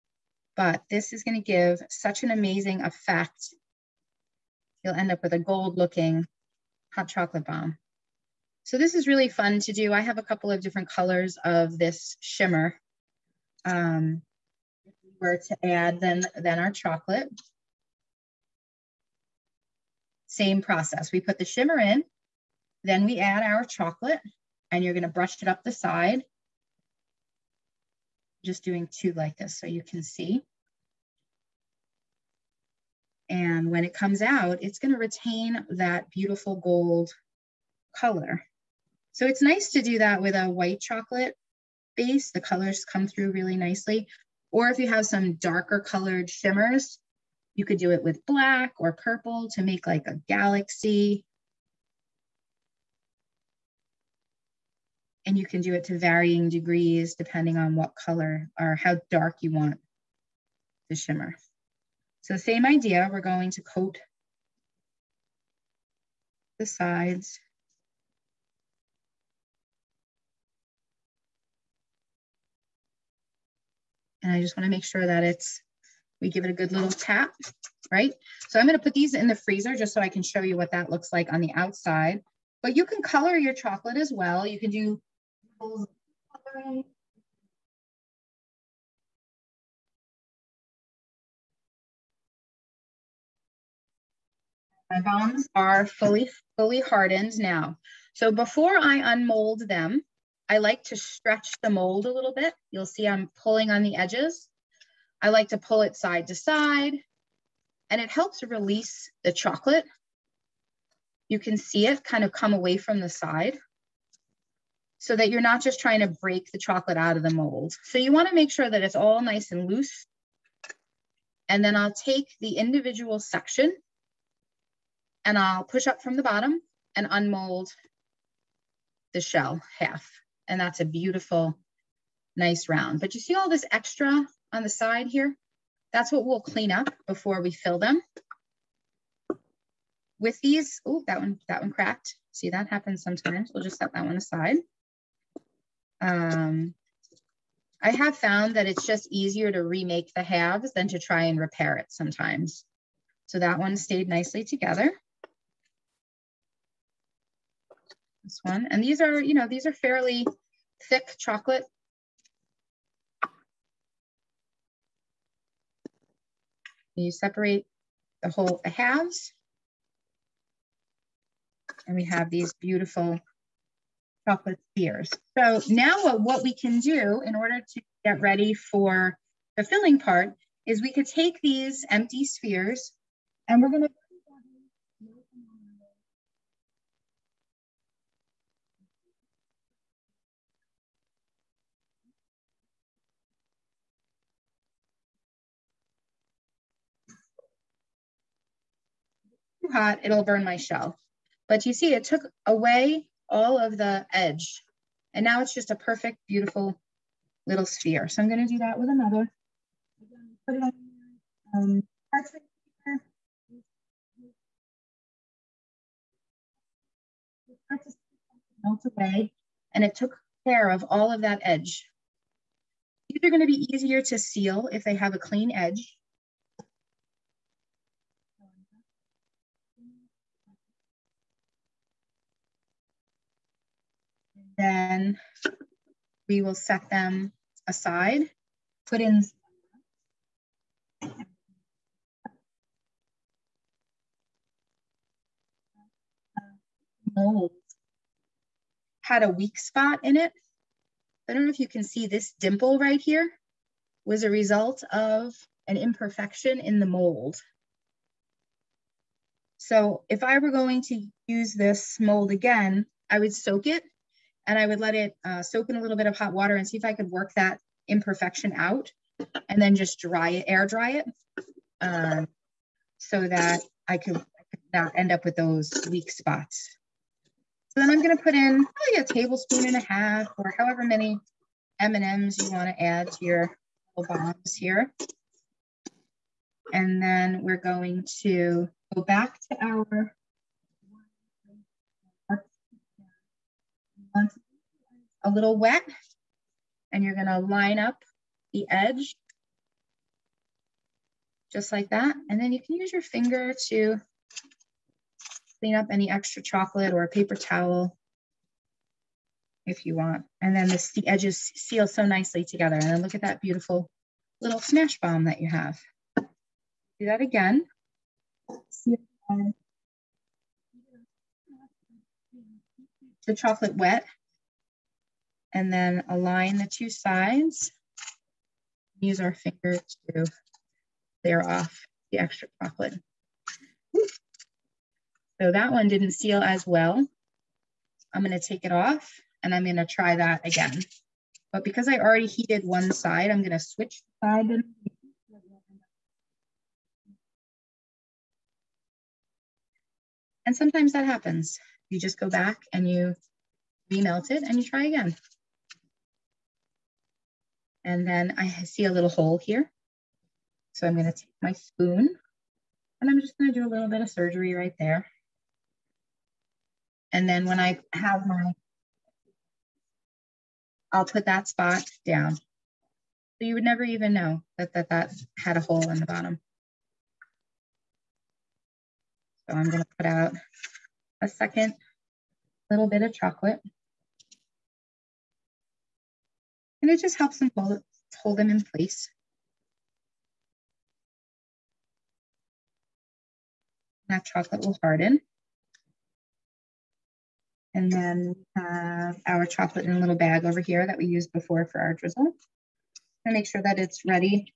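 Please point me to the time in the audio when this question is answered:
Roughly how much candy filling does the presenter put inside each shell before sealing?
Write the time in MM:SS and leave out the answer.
04:39.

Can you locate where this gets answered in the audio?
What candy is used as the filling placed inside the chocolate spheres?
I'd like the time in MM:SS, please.
04:41.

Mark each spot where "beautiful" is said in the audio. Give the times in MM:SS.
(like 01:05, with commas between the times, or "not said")
00:36, 02:10, 02:52, 03:26, 05:13.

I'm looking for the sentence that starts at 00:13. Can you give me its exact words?
Um, if we were to add then, then our chocolate, same process.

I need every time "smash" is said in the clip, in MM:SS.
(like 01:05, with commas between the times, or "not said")
05:14.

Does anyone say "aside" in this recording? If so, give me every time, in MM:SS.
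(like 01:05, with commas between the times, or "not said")
02:24, 03:57.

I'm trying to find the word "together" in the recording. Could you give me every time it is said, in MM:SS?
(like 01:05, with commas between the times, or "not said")
02:34, 05:12.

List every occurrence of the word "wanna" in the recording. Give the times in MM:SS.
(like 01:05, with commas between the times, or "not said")
01:14, 01:58, 04:42.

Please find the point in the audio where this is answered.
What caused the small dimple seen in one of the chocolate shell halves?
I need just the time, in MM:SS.
04:15.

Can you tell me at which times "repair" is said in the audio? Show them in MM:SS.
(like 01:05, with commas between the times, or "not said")
02:31.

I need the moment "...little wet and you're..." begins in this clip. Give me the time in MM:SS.
04:55.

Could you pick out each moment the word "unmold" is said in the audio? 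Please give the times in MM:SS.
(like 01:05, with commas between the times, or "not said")
01:39, 02:07.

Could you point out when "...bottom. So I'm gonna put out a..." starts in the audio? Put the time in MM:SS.
06:16.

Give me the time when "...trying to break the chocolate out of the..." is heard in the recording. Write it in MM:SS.
01:55.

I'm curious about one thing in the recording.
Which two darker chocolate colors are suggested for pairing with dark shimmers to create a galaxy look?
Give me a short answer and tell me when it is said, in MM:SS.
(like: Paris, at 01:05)
Black or purple, at 00:48.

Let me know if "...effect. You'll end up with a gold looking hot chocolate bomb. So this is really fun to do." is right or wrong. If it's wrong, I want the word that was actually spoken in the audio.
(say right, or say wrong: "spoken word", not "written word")
right.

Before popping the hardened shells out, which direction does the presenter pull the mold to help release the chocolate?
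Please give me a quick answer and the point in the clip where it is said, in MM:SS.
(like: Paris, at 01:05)
Side to side, at 01:45.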